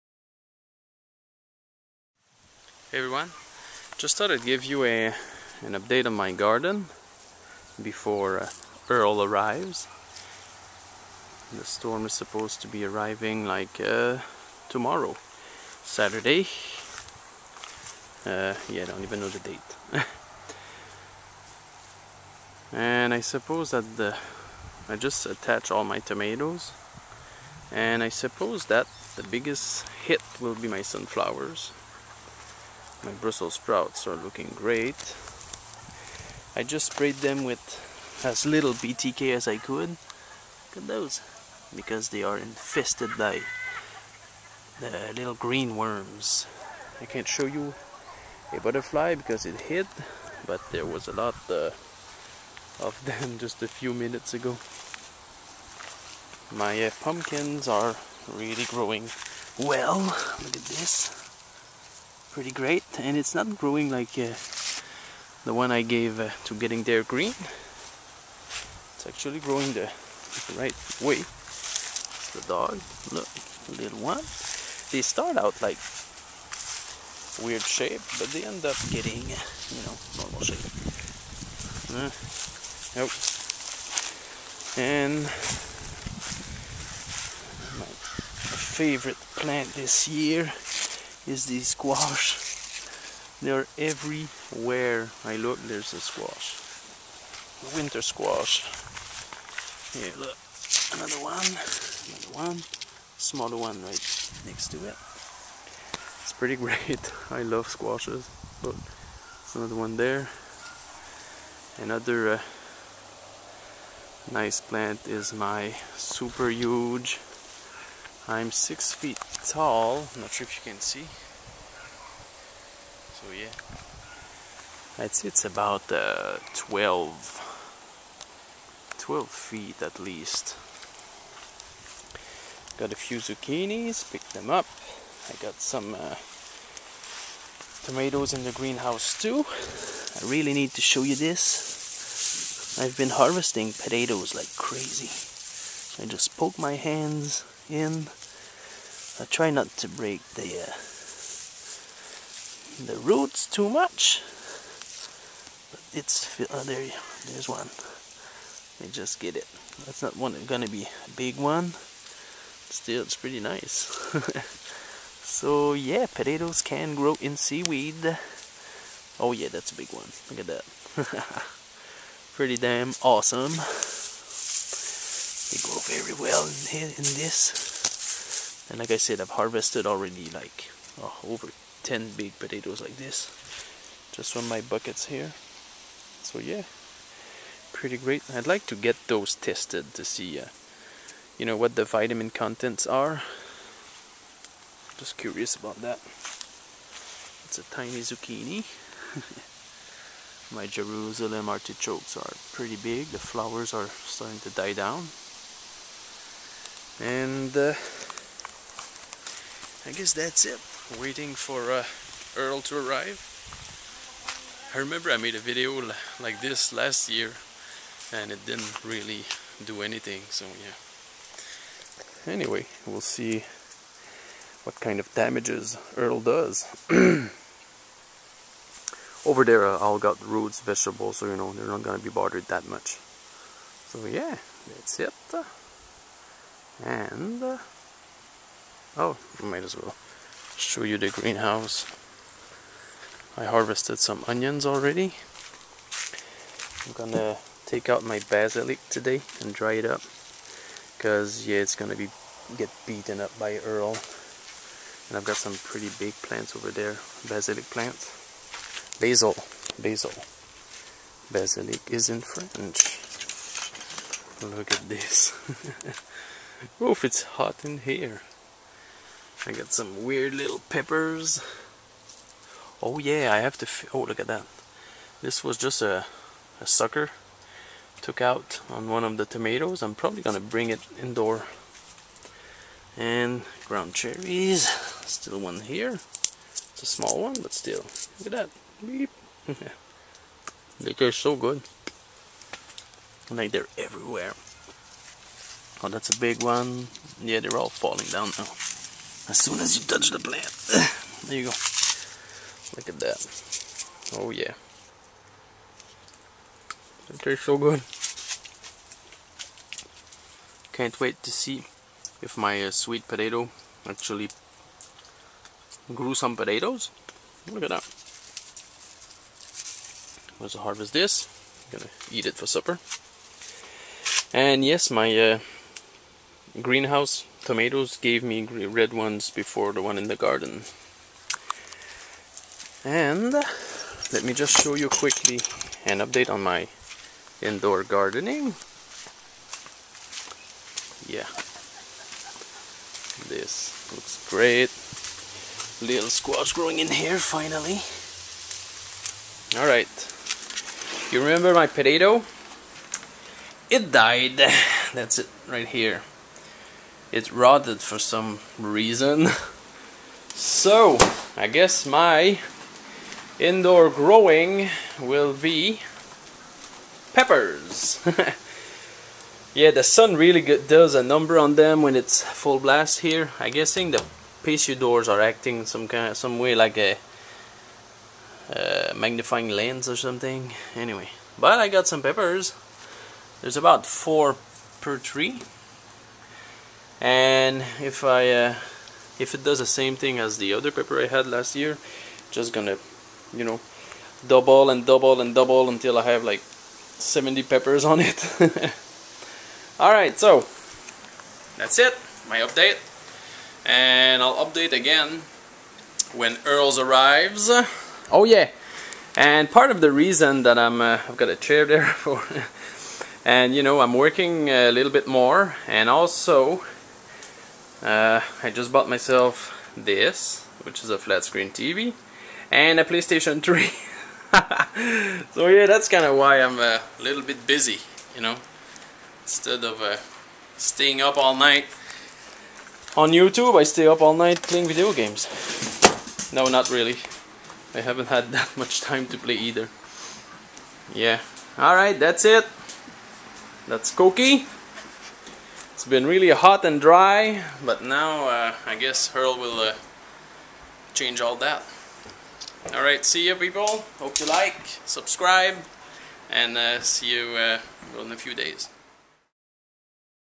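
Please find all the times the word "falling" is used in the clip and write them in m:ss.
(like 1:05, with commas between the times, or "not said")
4:57.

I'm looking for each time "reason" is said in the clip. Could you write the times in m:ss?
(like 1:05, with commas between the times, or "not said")
5:58, 6:49.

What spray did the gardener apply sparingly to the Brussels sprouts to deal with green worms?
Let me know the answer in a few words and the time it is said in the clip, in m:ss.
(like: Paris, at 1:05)
BTK, at 0:38.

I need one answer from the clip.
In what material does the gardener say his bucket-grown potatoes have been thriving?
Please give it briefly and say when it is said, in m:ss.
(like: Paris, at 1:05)
seaweed, at 2:47.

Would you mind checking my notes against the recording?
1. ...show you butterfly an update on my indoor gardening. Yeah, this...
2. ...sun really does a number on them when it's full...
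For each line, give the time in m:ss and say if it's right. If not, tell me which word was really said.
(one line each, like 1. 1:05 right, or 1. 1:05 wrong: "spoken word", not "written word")
1. 5:34 wrong: "quickly", not "butterfly"
2. 6:09 right.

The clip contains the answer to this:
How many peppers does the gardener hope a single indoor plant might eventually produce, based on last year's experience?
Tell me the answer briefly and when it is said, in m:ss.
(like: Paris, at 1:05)
70, at 6:36.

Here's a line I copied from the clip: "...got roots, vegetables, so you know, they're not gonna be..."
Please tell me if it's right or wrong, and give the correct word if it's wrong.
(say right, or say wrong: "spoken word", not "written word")
right.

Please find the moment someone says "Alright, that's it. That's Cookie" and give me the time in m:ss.
7:21.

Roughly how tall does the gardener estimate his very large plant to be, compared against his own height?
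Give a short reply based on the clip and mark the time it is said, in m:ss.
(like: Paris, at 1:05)
12 feet, at 2:08.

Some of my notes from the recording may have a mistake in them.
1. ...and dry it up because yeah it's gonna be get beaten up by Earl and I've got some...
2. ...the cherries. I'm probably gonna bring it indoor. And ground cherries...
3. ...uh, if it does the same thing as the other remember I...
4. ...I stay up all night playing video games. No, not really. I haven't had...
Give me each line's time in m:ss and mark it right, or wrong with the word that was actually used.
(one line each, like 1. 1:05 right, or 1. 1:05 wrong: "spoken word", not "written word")
1. 4:09 right
2. 4:39 wrong: "tomatoes", not "cherries"
3. 6:28 wrong: "pepper", not "remember"
4. 7:13 right.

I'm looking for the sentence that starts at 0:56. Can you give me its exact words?
My uh, pumpkins are really growing well.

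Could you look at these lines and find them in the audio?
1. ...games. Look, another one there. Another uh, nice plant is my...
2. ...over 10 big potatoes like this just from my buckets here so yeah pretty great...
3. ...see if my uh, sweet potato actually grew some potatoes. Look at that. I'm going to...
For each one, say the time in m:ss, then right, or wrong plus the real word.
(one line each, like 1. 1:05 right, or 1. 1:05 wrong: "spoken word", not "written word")
1. 1:47 wrong: "squashes", not "games"
2. 3:01 right
3. 5:11 right.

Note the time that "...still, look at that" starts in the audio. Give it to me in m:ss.
4:47.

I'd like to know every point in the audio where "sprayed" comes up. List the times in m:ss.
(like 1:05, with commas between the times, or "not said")
0:36.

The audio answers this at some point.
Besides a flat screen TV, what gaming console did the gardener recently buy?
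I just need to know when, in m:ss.
7:02.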